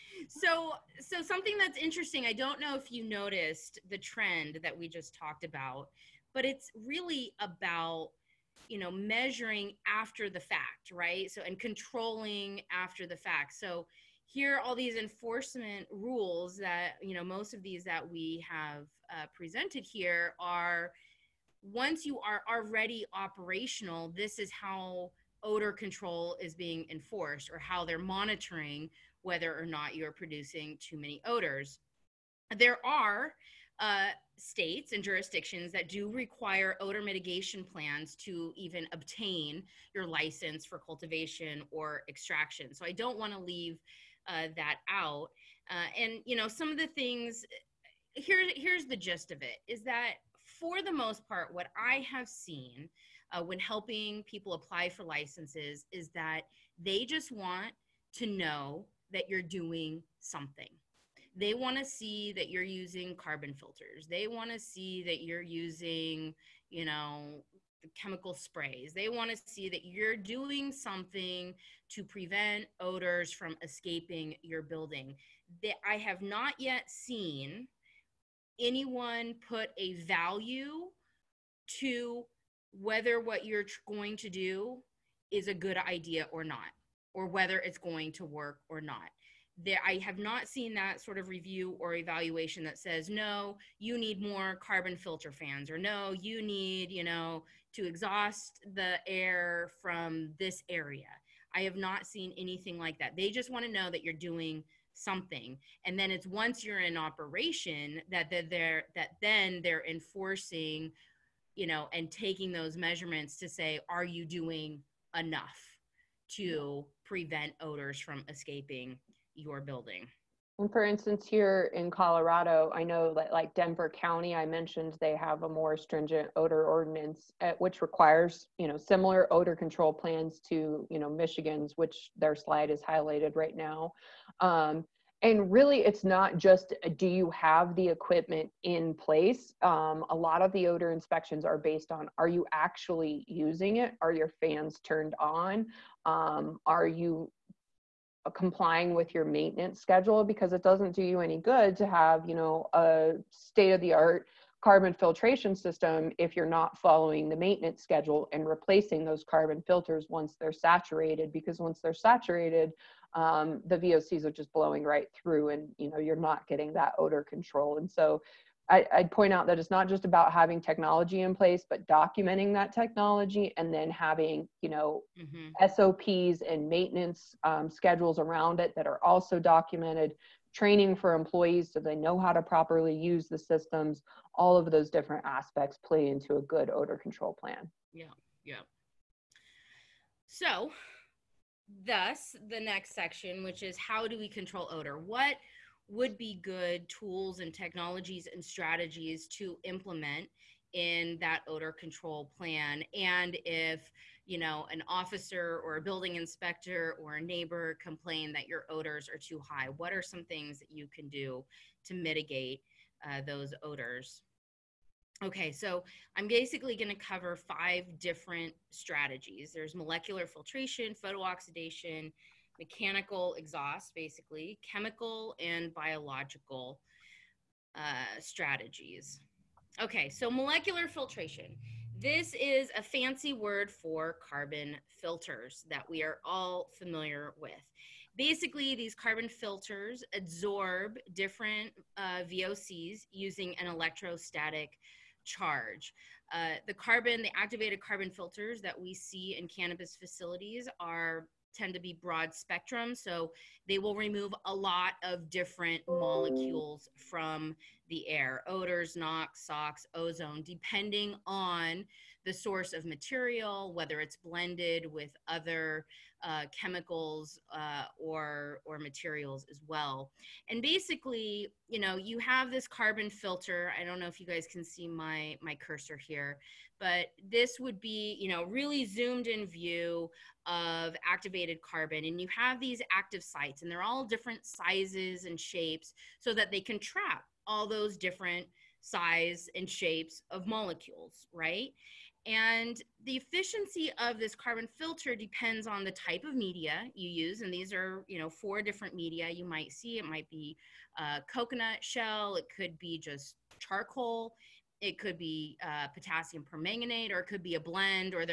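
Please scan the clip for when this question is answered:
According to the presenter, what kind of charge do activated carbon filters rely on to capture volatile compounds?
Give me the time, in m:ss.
4:03.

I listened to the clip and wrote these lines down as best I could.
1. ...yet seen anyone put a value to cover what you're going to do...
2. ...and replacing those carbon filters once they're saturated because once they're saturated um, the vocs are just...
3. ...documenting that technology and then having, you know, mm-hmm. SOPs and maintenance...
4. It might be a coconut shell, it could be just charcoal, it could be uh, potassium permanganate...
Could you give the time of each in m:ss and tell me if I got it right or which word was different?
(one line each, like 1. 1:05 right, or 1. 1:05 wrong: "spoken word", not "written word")
1. 1:16 wrong: "whether", not "cover"
2. 2:38 right
3. 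2:51 right
4. 4:59 right.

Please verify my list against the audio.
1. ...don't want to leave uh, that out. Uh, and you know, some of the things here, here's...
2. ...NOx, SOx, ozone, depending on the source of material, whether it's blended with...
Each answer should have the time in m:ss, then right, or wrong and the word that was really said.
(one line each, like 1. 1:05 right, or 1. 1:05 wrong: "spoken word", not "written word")
1. 0:42 right
2. 4:18 right.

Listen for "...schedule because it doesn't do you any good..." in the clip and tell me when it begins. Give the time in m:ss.
2:29.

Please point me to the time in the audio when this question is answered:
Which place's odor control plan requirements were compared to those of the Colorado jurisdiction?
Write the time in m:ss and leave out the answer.
2:11.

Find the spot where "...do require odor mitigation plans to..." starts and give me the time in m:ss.
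0:35.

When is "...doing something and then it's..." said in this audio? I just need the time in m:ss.
1:44.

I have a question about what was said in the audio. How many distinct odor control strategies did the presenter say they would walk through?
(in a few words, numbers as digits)
5.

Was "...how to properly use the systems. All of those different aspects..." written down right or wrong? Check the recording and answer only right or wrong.
right.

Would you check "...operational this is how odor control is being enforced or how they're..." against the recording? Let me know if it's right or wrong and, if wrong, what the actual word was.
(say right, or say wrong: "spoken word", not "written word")
right.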